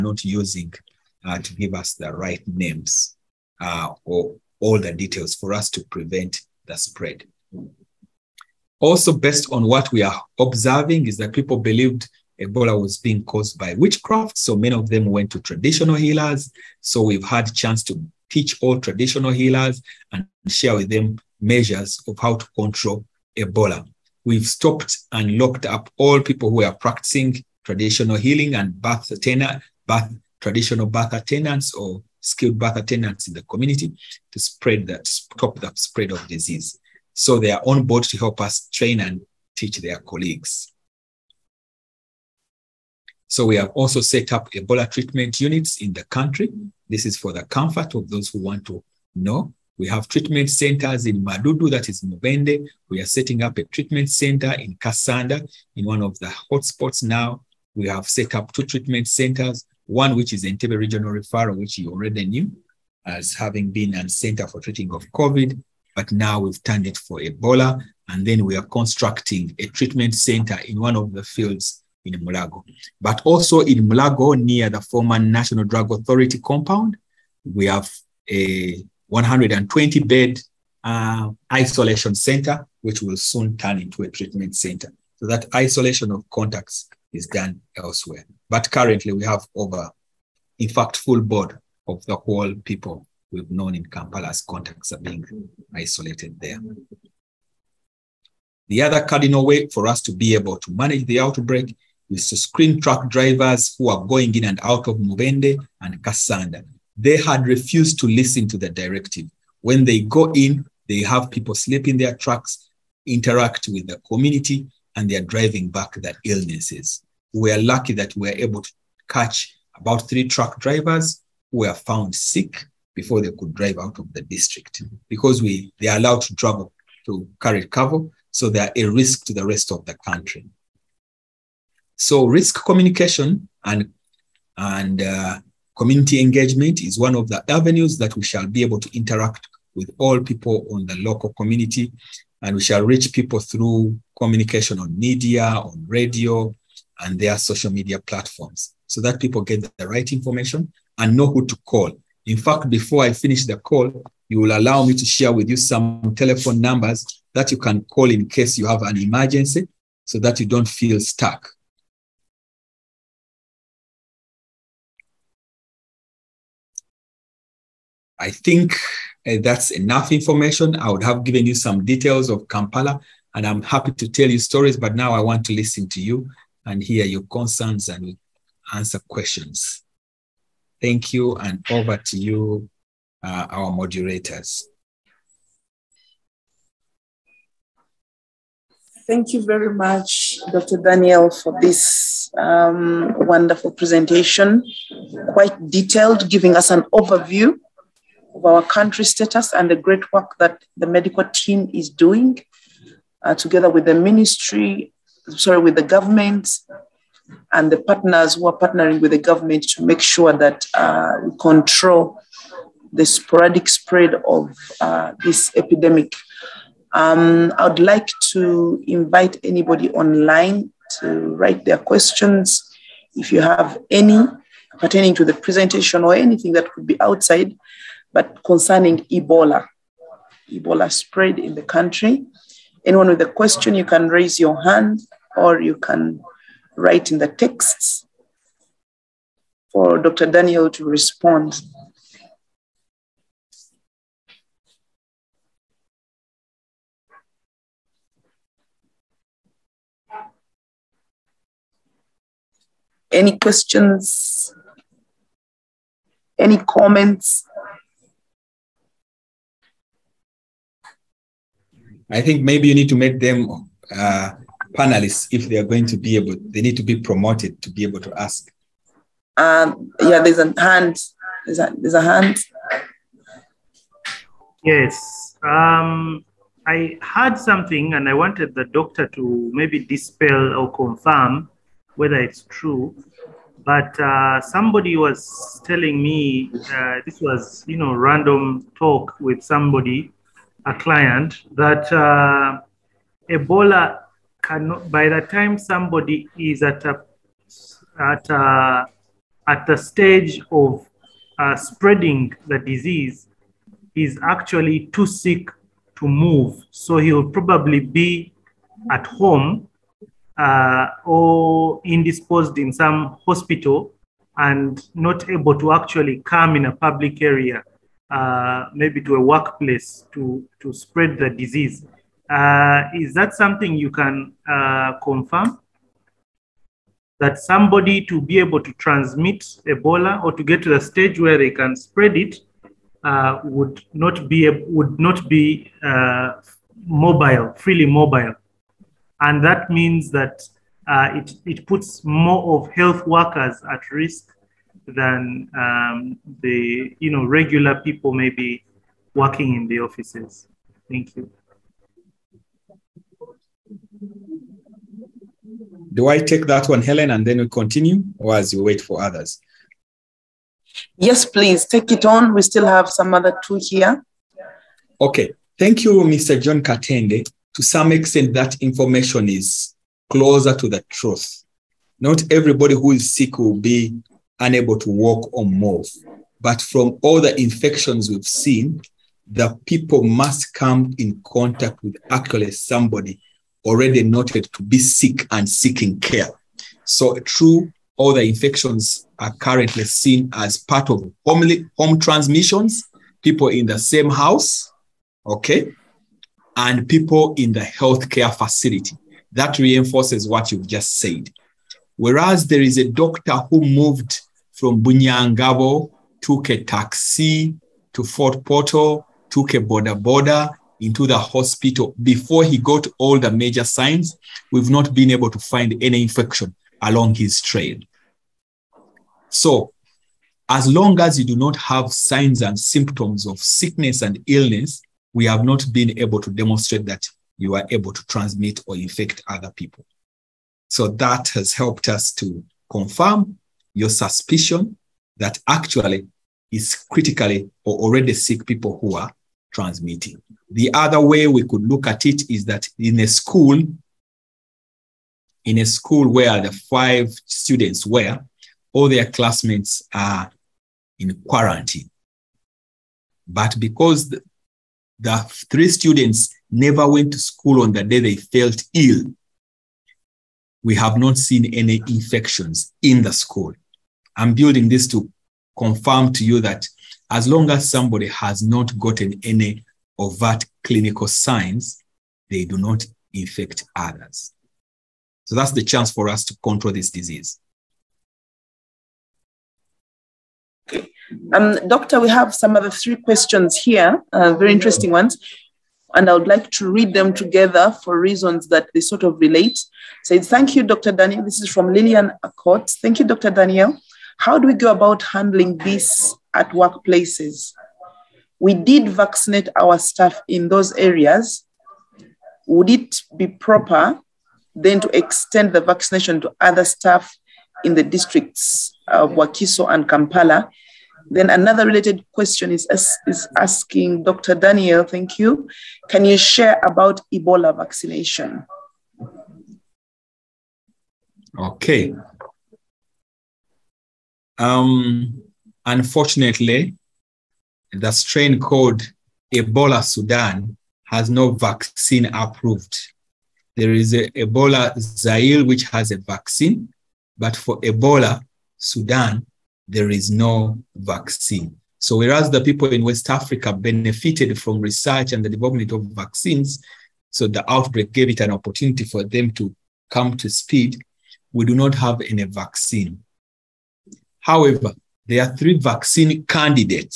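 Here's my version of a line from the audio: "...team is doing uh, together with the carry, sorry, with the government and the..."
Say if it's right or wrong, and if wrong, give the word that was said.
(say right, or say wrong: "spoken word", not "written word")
wrong: "ministry", not "carry".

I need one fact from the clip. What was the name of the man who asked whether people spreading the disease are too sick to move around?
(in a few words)
John Katende.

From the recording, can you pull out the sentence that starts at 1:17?
We have a 120 bed uh, isolation center, which will soon turn into a treatment center.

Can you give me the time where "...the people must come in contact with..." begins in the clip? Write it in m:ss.
6:19.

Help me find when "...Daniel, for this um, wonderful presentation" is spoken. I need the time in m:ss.
3:10.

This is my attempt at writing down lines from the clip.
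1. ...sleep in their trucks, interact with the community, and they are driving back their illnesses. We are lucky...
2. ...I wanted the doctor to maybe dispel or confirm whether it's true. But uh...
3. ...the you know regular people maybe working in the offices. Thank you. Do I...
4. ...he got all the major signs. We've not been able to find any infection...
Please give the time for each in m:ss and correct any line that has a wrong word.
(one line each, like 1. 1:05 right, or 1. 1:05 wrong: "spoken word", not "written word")
1. 1:51 right
2. 4:38 right
3. 5:46 right
4. 6:52 right.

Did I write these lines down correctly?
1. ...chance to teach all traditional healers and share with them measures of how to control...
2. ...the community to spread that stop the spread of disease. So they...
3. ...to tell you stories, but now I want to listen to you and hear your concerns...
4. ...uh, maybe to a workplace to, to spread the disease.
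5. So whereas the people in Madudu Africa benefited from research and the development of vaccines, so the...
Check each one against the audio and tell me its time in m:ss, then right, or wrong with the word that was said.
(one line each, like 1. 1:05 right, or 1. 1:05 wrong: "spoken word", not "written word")
1. 0:17 right
2. 0:33 right
3. 2:53 right
4. 5:18 right
5. 9:01 wrong: "West", not "Madudu".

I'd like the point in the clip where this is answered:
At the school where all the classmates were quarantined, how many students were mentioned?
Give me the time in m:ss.
7:26.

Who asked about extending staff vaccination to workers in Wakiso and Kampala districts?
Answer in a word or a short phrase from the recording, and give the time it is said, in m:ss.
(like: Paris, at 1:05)
Lillian Accord, at 8:11.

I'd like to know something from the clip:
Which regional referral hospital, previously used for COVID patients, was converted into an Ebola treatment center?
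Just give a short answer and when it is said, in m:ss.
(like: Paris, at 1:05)
Entebbe, at 1:00.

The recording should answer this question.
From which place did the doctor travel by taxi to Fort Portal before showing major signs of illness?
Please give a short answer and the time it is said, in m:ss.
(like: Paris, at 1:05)
Bunyangabu, at 6:44.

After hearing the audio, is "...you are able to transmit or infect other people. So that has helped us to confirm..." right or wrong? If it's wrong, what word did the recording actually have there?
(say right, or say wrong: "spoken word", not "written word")
right.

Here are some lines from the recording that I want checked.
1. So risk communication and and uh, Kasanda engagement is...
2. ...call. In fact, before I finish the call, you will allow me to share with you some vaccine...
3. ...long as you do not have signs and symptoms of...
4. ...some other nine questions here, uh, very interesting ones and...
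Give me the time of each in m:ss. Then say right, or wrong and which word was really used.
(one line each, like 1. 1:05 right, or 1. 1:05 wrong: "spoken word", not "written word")
1. 2:11 wrong: "Community", not "Kasanda"
2. 2:31 wrong: "telephone", not "vaccine"
3. 7:00 right
4. 8:02 wrong: "three", not "nine".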